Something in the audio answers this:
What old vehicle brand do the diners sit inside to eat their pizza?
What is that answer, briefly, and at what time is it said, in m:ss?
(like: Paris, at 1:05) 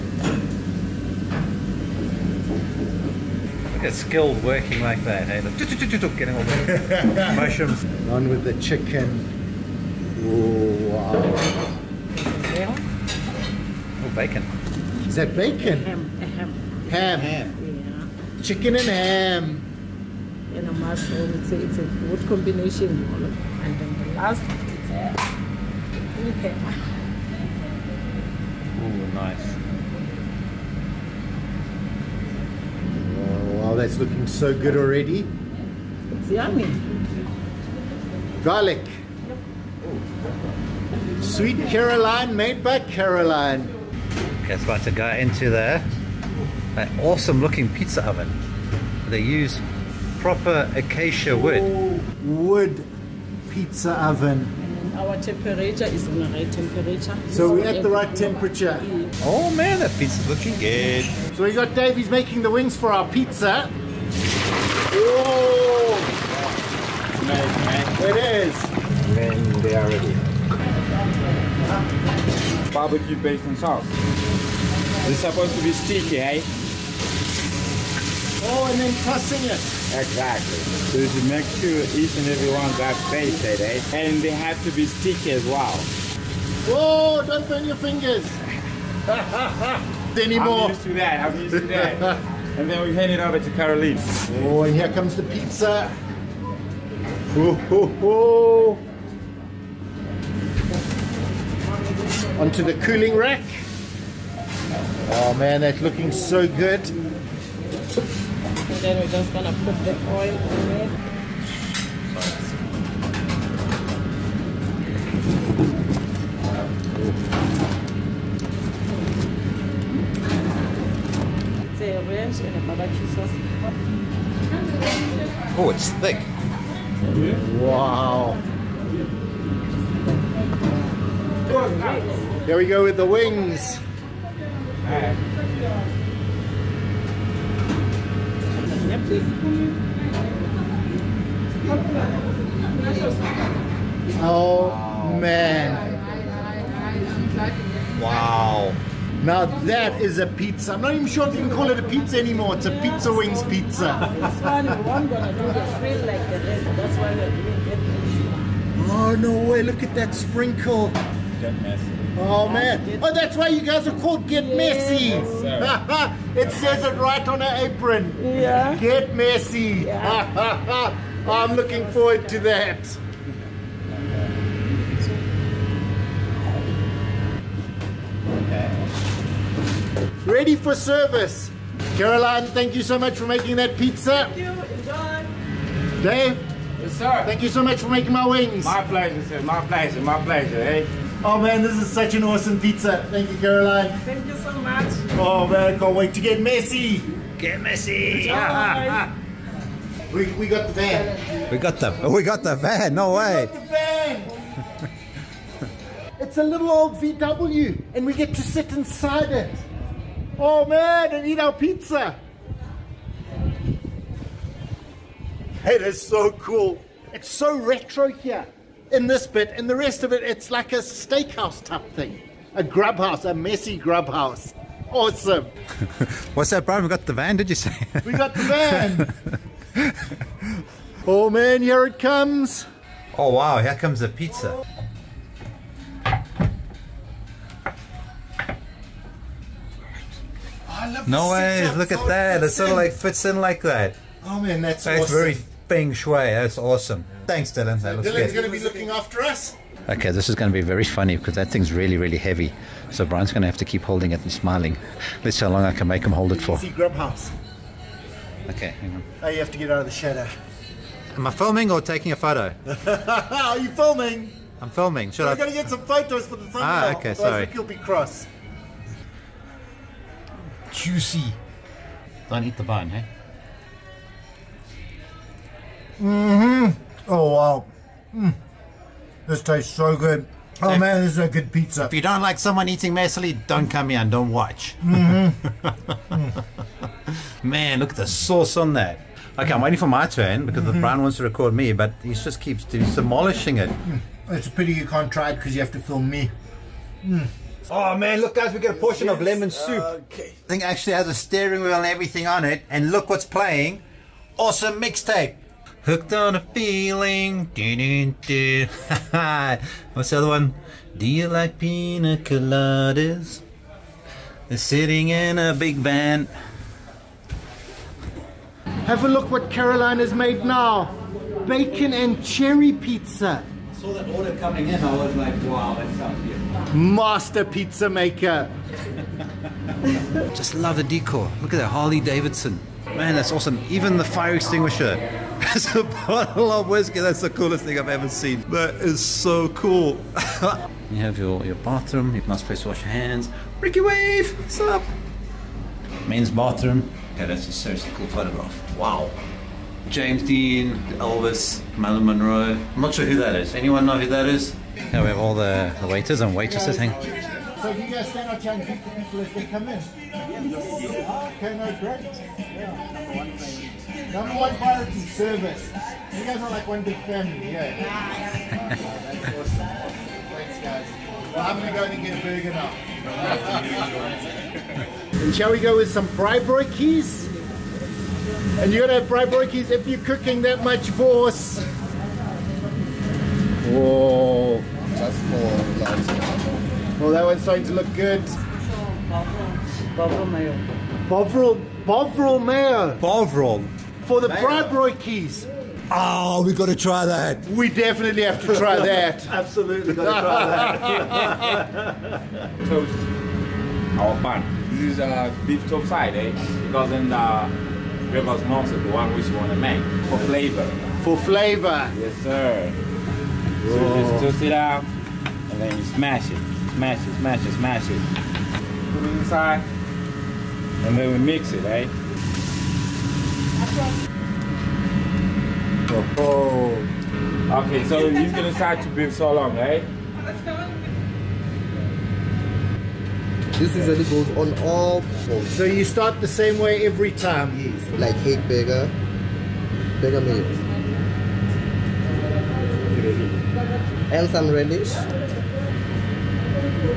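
VW, at 3:27.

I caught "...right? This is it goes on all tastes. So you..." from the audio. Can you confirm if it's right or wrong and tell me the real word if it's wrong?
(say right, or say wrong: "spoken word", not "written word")
wrong: "poles", not "tastes".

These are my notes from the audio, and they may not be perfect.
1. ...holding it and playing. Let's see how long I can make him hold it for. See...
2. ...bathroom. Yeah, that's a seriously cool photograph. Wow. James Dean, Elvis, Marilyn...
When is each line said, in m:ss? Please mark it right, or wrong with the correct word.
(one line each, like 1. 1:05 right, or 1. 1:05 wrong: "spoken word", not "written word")
1. 4:13 wrong: "smiling", not "playing"
2. 5:46 right.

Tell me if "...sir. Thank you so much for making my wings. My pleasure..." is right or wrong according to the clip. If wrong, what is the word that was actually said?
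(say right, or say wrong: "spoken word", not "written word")
right.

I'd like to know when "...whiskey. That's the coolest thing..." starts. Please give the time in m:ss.
5:36.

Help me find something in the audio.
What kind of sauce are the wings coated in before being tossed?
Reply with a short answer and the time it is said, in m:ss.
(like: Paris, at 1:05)
Barbecue, at 1:12.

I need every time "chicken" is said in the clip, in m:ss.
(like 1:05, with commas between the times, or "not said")
0:08, 0:18.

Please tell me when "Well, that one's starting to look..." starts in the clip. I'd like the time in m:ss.
6:27.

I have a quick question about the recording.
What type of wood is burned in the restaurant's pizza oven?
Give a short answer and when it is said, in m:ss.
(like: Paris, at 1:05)
Acacia, at 0:50.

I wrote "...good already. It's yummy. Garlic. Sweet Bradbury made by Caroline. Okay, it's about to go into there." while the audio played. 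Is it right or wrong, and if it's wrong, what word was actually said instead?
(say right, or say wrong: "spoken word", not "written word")
wrong: "Caroline", not "Bradbury".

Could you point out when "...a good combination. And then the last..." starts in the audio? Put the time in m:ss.
0:21.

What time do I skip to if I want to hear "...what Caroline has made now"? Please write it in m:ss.
5:19.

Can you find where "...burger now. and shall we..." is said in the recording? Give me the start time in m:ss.
6:12.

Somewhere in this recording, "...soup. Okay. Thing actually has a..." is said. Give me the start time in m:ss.
4:59.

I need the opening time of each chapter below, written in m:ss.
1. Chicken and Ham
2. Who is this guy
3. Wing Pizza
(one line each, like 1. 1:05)
1. 0:17
2. 5:49
3. 2:43.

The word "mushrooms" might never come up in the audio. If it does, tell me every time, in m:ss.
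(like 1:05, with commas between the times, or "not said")
0:07, 0:20.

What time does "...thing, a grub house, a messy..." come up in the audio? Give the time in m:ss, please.
3:41.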